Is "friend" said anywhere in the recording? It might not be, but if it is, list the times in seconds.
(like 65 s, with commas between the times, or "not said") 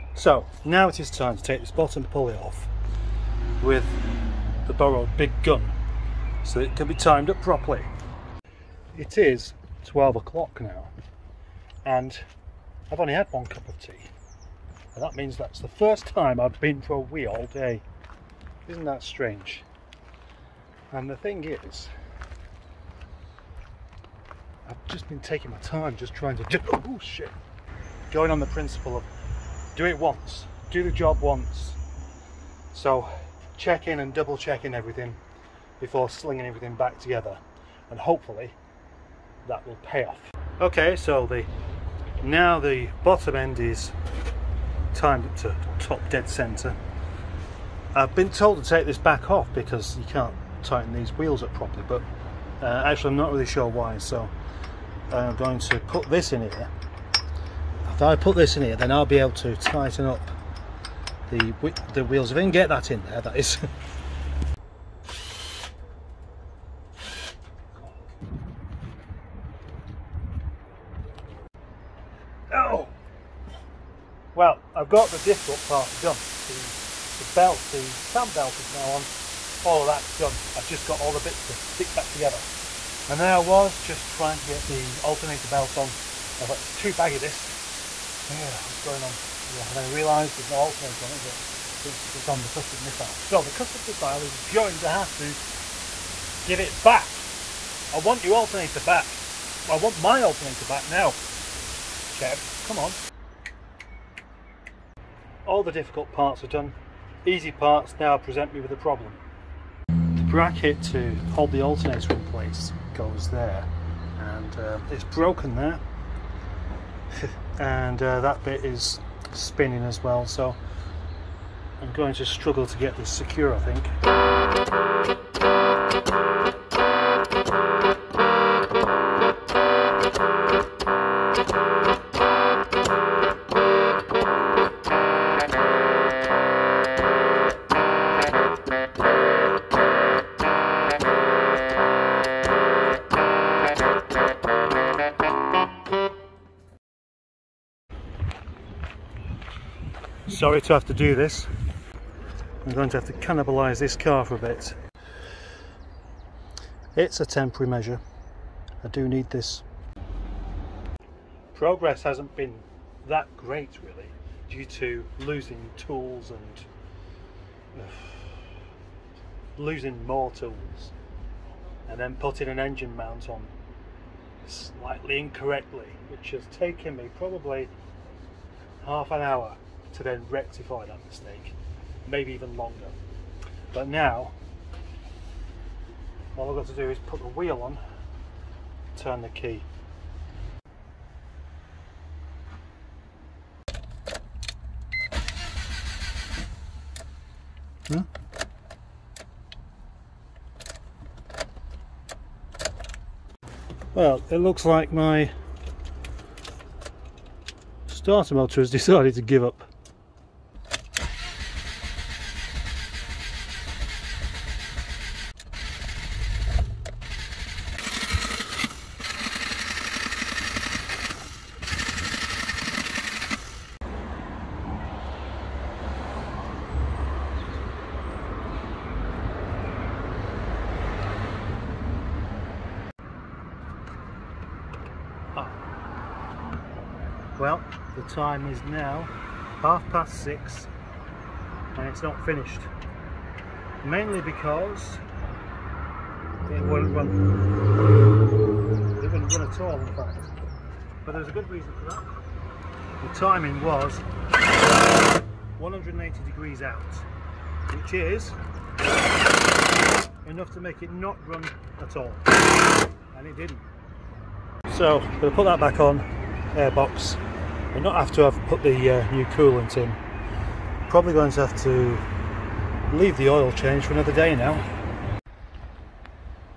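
not said.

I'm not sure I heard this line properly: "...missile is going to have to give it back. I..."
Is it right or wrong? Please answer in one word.
right.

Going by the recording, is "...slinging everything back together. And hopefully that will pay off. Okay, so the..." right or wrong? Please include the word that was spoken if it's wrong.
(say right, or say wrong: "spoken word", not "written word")
right.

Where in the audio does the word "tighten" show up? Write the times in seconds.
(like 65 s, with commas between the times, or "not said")
50 s, 59 s.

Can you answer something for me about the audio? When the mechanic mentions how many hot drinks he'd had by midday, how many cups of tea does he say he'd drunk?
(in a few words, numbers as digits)
1.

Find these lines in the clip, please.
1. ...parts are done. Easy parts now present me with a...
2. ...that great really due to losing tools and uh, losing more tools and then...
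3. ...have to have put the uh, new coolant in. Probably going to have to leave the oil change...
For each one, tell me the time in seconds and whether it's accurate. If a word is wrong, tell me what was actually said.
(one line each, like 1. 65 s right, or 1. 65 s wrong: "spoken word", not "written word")
1. 106 s right
2. 163 s right
3. 267 s right.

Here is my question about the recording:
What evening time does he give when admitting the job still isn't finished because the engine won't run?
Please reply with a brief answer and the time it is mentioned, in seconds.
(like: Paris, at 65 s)
half past six, at 239 s.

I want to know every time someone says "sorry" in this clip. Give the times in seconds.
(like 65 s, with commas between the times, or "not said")
150 s.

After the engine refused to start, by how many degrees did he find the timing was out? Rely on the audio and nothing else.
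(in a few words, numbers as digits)
180.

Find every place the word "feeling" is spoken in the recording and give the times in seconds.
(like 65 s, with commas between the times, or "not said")
not said.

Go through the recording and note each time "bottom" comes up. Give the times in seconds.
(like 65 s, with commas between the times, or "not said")
1 s, 43 s.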